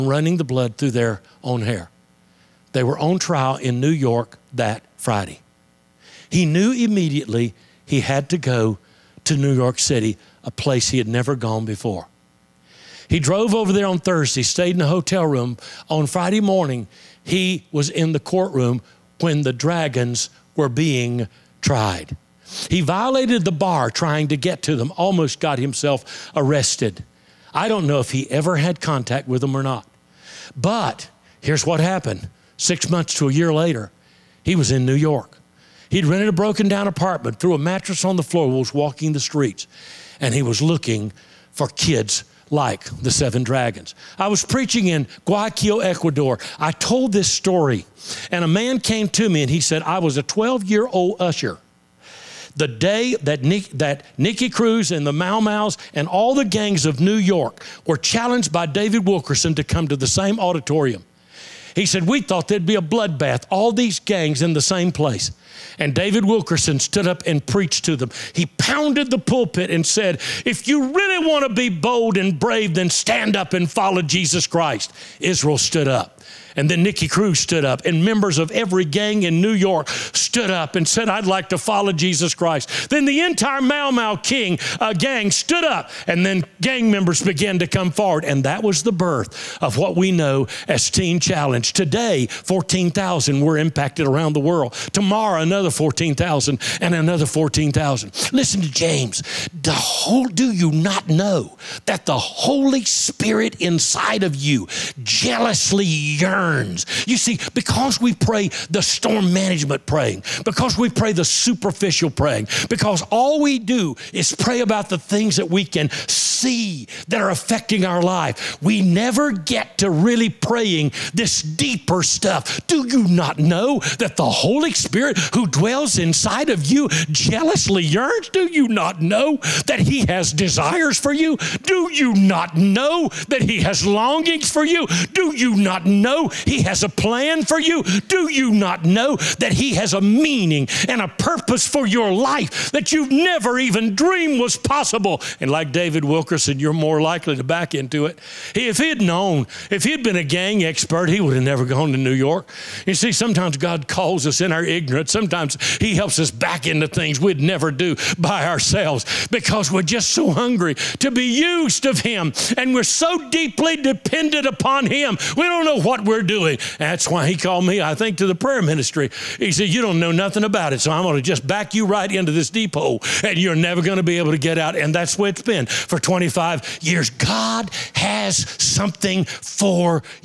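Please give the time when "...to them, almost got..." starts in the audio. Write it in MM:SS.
00:24.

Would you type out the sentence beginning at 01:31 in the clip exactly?
Today, 14,000 were impacted around the world.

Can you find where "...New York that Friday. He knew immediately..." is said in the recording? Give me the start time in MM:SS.
00:03.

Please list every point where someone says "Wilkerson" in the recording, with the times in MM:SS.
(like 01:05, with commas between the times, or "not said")
00:59, 01:06, 02:26.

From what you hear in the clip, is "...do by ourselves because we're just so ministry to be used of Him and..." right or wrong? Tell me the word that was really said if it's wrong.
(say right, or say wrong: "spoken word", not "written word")
wrong: "hungry", not "ministry".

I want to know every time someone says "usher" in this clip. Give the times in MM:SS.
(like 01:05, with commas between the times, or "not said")
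00:51.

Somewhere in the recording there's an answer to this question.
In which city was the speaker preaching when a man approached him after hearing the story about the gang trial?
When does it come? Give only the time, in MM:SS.
00:45.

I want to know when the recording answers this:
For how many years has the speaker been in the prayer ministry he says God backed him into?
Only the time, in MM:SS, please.
02:55.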